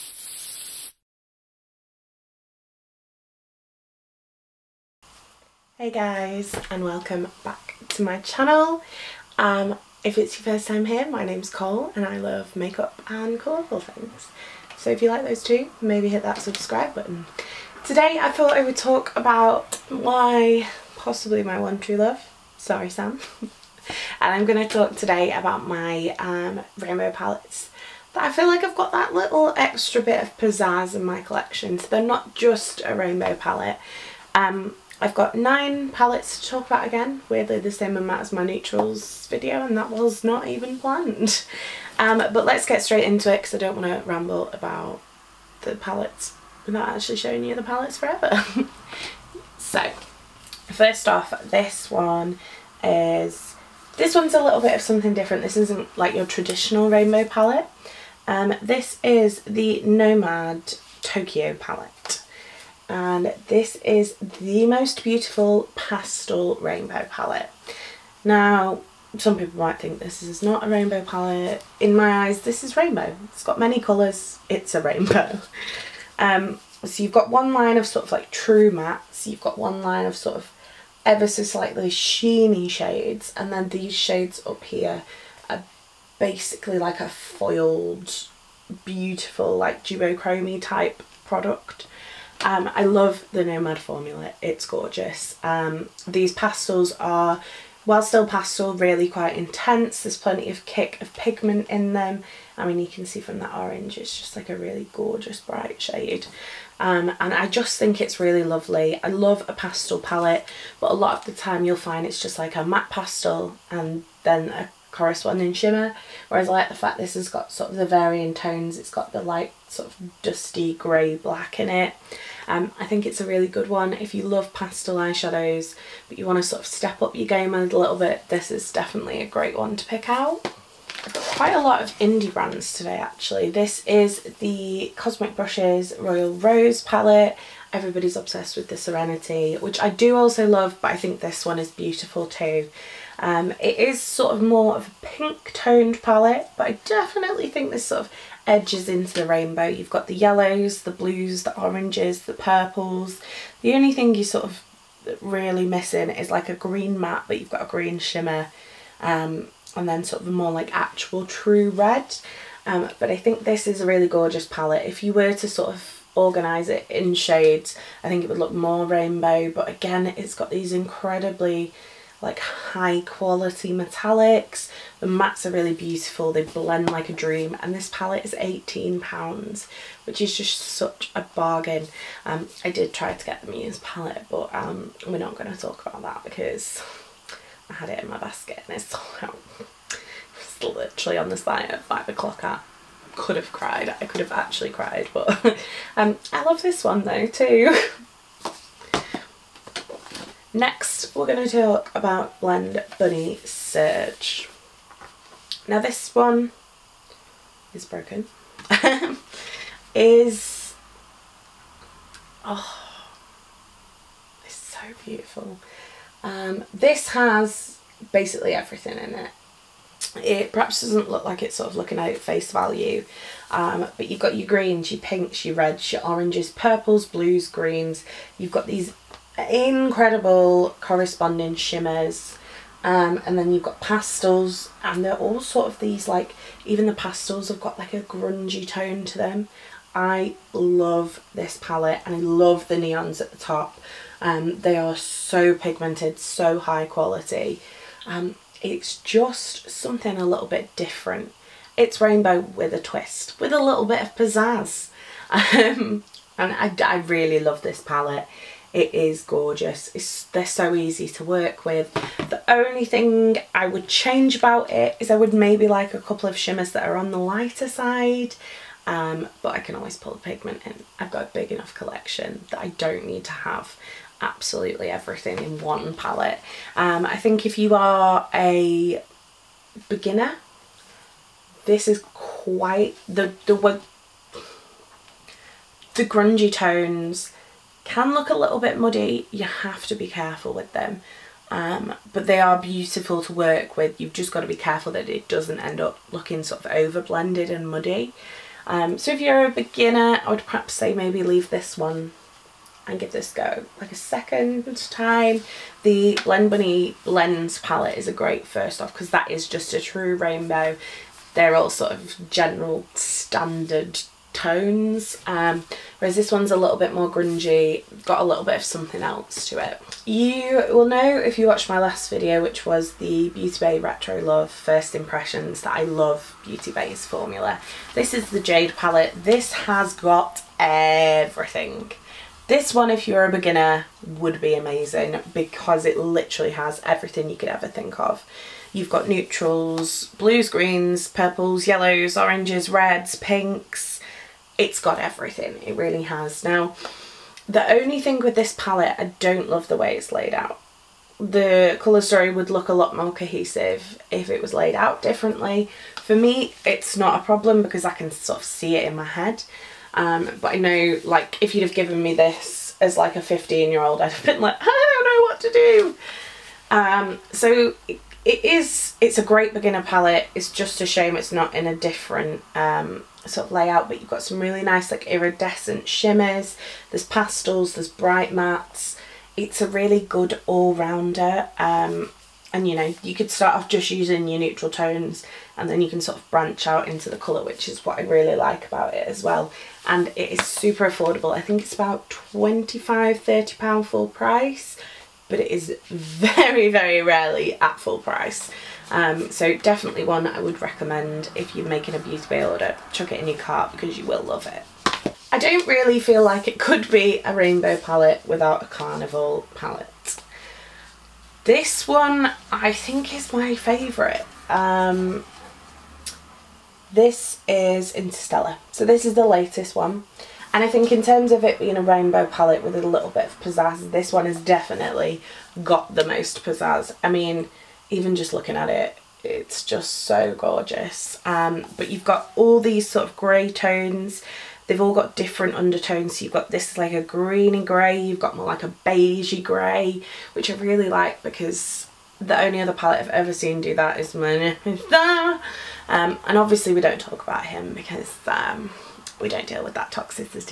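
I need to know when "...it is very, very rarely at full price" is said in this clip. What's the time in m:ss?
6:35.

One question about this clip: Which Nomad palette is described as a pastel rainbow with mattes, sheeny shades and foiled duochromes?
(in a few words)
Tokyo.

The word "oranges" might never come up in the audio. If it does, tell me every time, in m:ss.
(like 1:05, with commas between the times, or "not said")
1:43, 2:31, 3:46, 5:42.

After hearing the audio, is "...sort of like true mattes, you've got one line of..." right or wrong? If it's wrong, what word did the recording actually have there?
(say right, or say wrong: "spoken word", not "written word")
right.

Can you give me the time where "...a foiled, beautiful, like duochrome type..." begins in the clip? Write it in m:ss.
1:27.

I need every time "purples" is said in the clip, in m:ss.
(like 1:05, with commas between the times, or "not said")
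2:32, 3:46, 5:41.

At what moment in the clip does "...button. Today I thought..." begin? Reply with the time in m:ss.
0:16.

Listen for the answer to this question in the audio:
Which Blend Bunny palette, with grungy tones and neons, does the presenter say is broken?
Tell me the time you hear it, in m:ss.
3:23.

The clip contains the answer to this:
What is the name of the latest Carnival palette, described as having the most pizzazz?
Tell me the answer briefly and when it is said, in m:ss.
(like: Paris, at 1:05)
Interstellar, at 6:57.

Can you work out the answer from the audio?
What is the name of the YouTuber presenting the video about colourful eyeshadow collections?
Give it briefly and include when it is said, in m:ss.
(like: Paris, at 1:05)
Cole, at 0:11.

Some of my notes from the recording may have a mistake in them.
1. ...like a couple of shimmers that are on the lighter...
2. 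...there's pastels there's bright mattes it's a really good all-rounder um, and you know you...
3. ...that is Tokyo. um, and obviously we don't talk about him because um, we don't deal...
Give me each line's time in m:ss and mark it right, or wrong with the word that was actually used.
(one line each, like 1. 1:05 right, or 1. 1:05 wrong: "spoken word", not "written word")
1. 4:25 right
2. 6:16 right
3. 7:23 wrong: "Mona", not "Tokyo".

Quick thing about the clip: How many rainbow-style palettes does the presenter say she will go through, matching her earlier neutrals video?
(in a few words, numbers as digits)
9.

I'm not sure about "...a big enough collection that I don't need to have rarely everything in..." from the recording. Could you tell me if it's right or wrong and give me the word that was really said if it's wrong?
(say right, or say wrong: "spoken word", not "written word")
wrong: "absolutely", not "rarely".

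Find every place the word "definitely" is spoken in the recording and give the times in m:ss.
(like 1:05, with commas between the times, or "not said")
2:08, 2:26, 6:39, 7:04.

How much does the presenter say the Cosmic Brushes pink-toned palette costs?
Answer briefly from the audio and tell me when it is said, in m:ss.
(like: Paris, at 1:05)
£18, at 2:58.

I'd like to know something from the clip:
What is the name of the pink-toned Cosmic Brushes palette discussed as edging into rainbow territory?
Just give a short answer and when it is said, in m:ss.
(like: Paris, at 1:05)
Royal Rose, at 2:15.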